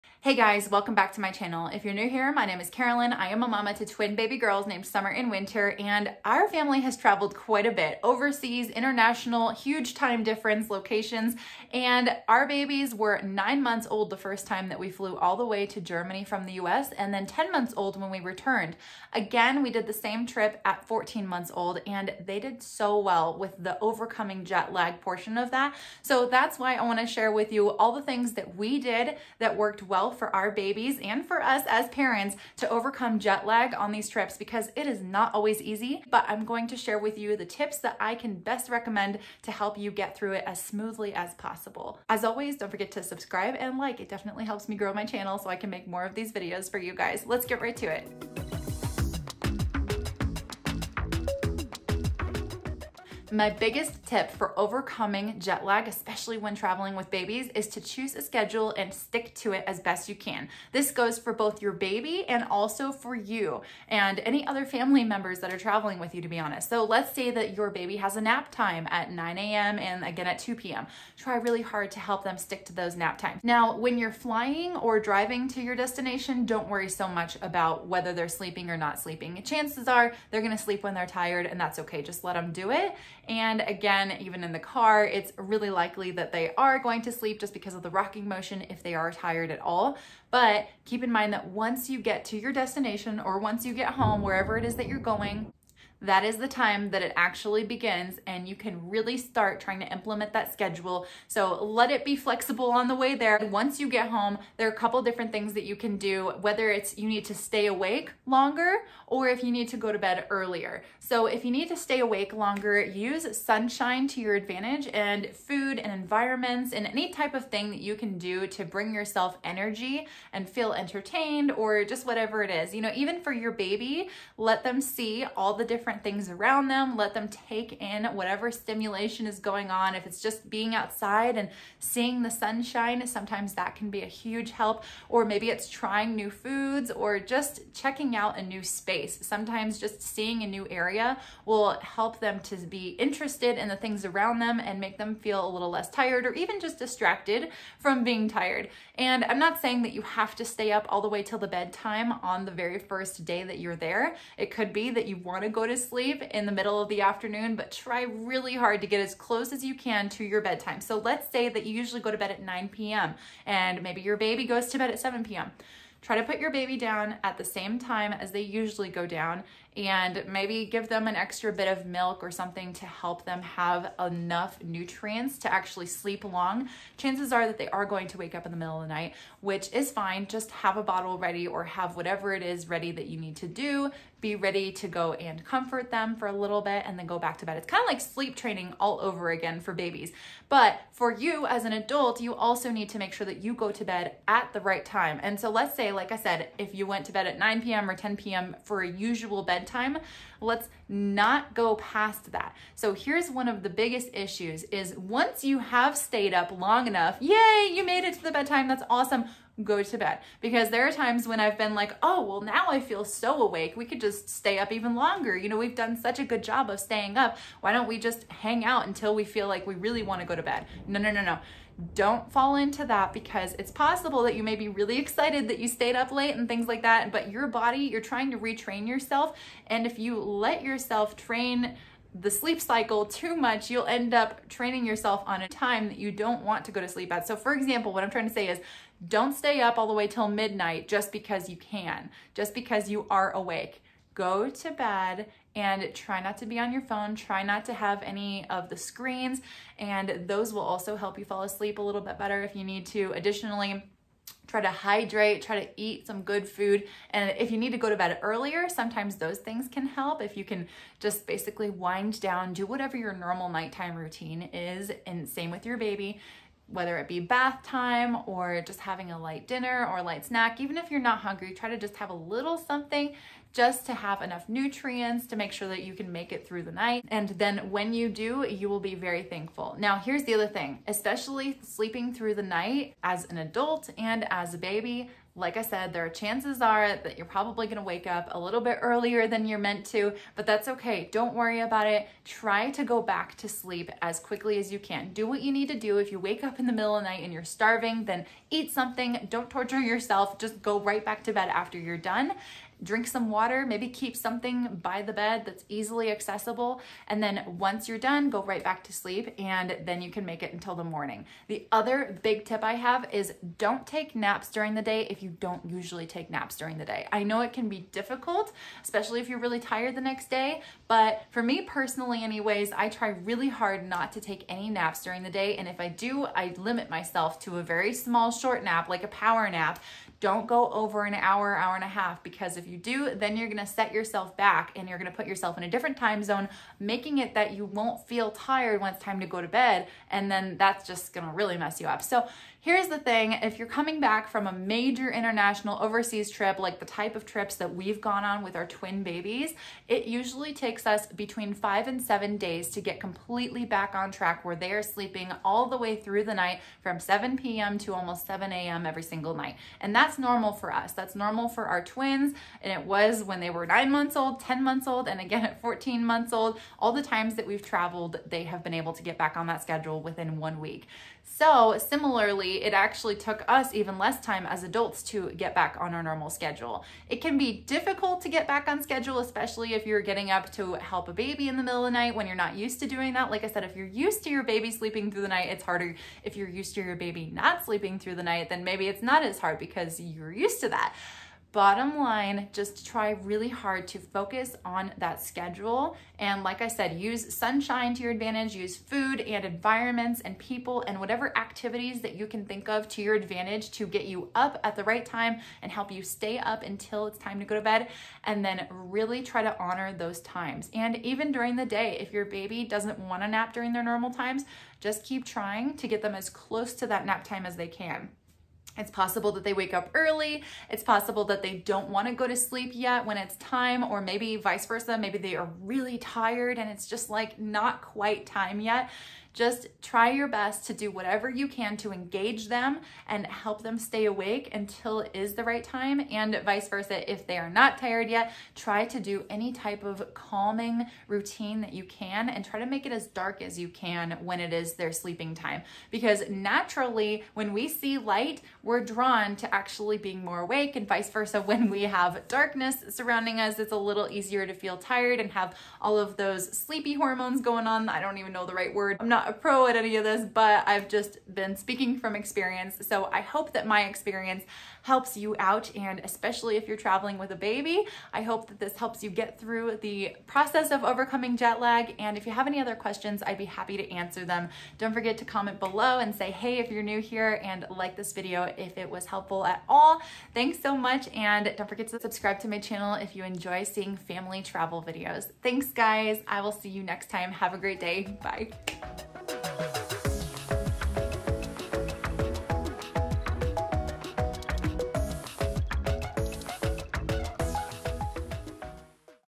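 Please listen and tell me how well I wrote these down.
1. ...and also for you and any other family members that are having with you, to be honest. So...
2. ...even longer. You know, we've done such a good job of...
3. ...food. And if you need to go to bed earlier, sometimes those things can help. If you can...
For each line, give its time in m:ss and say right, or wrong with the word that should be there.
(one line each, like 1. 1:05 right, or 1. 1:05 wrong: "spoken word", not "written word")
1. 1:02 wrong: "traveling", not "having"
2. 3:34 right
3. 4:16 right.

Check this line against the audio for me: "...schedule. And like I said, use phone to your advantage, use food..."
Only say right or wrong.
wrong.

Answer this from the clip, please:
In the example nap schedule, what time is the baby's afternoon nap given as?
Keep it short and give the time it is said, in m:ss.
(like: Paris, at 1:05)
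2 p.m., at 1:10.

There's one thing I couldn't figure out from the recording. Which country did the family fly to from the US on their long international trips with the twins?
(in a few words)
Germany.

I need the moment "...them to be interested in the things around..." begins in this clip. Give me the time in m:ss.
2:22.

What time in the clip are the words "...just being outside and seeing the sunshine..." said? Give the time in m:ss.
2:10.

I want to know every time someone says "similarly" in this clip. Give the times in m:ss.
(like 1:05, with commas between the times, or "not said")
6:11.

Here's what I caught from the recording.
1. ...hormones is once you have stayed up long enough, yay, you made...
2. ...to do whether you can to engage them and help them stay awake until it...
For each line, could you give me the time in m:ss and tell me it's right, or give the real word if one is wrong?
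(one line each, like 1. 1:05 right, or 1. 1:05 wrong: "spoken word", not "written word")
1. 3:24 wrong: "issues", not "hormones"
2. 7:10 wrong: "whatever", not "whether".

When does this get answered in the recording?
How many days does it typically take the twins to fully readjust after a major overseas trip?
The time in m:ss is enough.
5:51.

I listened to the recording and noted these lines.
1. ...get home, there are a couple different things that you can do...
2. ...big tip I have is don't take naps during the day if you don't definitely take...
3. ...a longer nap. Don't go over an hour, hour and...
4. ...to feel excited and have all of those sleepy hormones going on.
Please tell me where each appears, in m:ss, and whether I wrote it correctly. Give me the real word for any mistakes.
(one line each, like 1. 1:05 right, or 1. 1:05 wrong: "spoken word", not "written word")
1. 1:43 right
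2. 5:12 wrong: "usually", not "definitely"
3. 5:29 wrong: "power", not "longer"
4. 7:34 wrong: "tired", not "excited".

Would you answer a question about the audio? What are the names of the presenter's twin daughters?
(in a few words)
Summer and Winter.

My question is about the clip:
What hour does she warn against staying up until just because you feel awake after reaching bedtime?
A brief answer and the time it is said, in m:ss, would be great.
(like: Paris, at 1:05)
midnight, at 4:00.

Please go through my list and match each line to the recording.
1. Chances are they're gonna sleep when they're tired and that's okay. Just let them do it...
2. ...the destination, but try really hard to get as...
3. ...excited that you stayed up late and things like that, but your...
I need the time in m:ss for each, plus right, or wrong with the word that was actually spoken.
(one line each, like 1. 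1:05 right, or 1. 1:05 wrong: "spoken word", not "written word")
1. 1:19 right
2. 2:36 wrong: "afternoon", not "destination"
3. 3:44 right.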